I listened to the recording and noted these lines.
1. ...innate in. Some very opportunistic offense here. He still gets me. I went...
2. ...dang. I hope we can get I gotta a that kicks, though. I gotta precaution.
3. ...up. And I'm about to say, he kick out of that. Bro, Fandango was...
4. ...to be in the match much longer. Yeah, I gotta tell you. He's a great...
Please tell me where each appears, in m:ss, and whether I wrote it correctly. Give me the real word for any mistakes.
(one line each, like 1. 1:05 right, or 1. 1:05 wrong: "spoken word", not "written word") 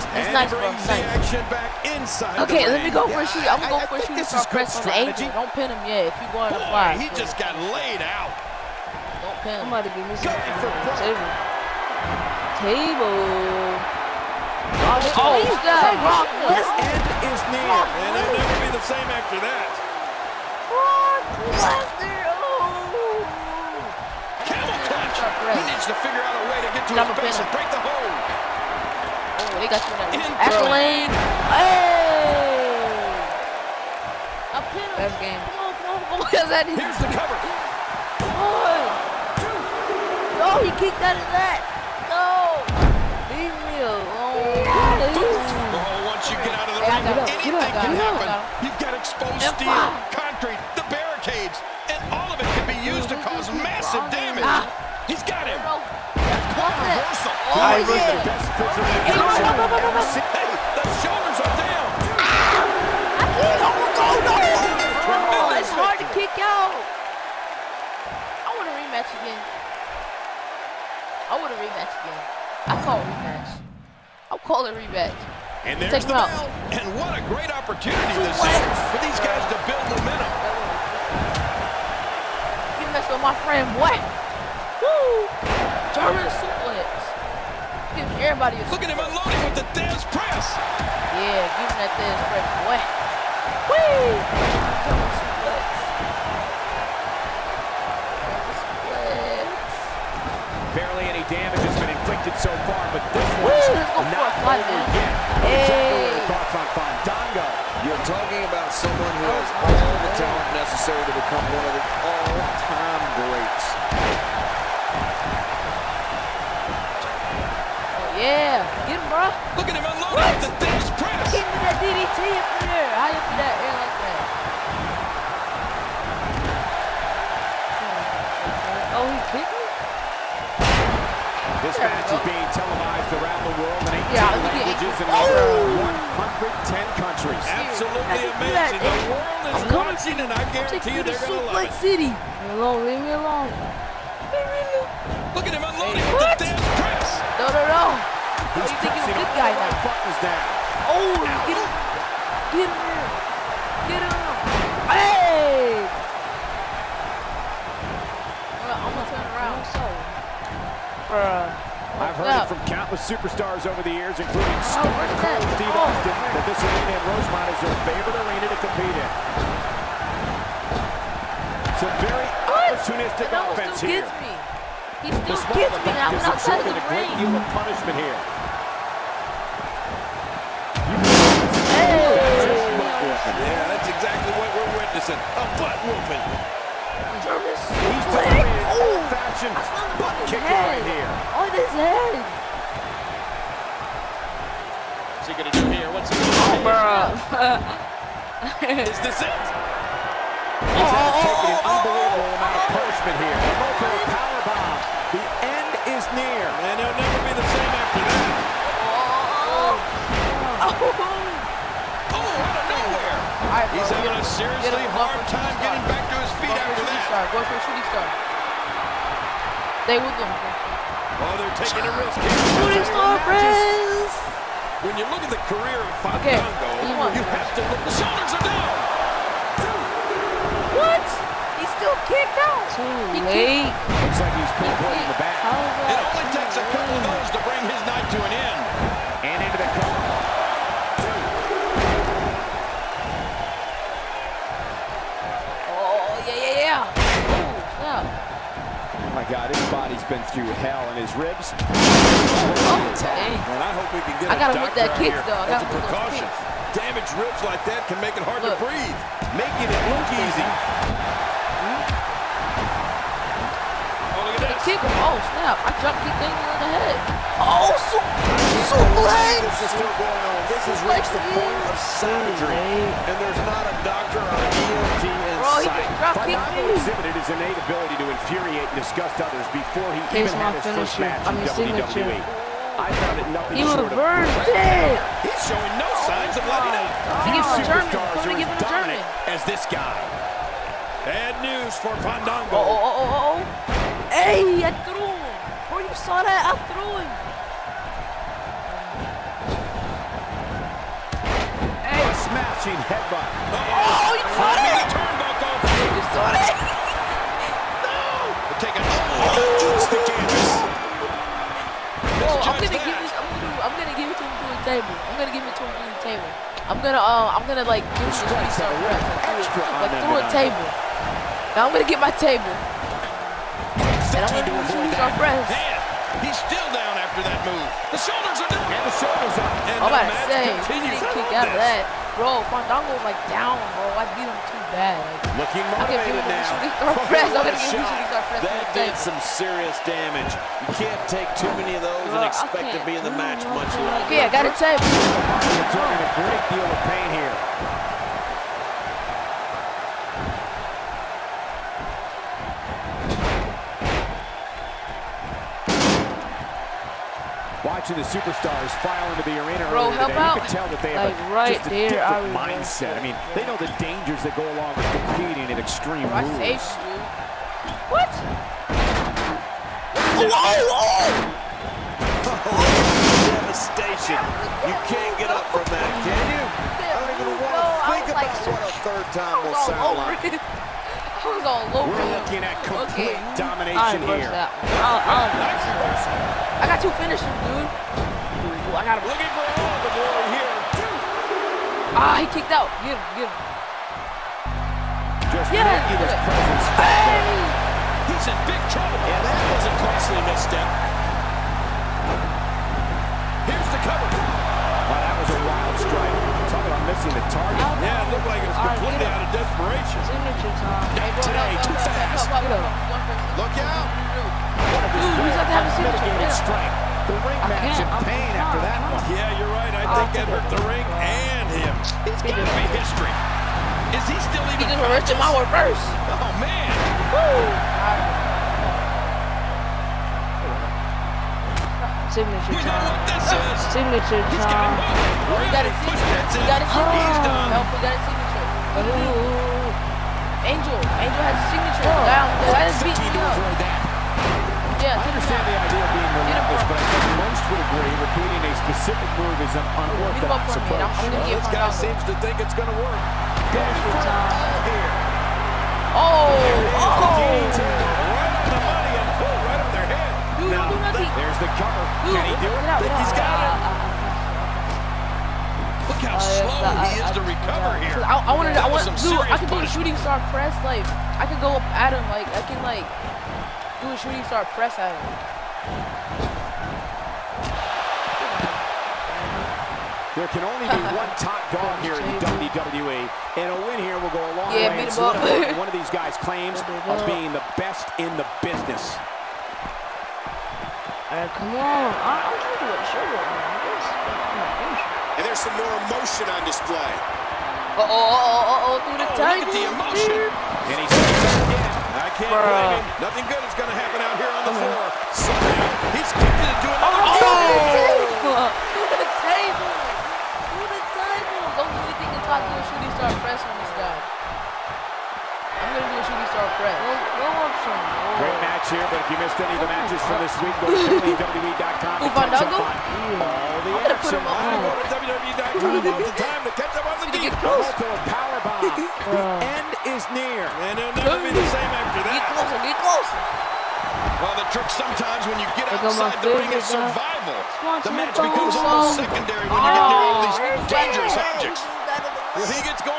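1. 2:48 wrong: "compete", not "innate"
2. 4:12 right
3. 5:29 right
4. 5:42 right.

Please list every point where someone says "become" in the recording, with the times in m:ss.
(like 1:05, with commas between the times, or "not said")
1:51, 8:58.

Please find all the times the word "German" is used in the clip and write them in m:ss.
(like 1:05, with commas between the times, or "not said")
1:25, 1:34.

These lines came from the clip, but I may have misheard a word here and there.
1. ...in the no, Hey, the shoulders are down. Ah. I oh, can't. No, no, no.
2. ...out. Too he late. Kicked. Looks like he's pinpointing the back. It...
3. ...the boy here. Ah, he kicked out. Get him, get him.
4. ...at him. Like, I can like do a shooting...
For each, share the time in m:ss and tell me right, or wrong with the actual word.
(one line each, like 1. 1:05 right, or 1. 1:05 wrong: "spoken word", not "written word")
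1. 0:59 right
2. 3:52 right
3. 6:29 right
4. 7:51 right.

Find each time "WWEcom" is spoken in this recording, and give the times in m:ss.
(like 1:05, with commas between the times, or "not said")
8:41, 8:45.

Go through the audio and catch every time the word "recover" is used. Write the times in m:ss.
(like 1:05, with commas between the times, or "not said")
7:47.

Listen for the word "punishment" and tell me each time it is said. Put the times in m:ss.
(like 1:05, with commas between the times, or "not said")
2:57, 3:22.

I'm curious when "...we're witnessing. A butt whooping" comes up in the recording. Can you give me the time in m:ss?
3:04.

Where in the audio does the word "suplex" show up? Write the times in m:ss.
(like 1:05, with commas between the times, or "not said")
1:26, 1:40, 4:28.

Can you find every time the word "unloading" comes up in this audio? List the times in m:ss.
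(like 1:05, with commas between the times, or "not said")
1:28, 2:25.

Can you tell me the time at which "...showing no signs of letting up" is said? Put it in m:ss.
4:45.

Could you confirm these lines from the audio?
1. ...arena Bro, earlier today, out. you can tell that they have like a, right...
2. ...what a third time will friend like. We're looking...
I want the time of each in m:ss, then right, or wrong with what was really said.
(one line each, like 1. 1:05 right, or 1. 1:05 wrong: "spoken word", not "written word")
1. 5:59 right
2. 6:18 wrong: "sound", not "friend".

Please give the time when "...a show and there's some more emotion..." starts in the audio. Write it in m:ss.
8:12.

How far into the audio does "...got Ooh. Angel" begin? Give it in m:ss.
7:17.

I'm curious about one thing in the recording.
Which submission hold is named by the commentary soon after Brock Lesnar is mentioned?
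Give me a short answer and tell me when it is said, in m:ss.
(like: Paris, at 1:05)
Camel clutch, at 0:24.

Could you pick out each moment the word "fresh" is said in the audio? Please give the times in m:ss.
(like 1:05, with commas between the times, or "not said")
5:25, 8:36.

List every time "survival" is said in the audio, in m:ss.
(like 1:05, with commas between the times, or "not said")
8:56.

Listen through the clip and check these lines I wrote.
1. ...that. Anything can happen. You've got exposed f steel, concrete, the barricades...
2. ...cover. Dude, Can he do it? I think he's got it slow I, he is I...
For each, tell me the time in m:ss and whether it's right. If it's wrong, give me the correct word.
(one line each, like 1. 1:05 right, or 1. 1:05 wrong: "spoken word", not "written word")
1. 0:41 right
2. 7:41 right.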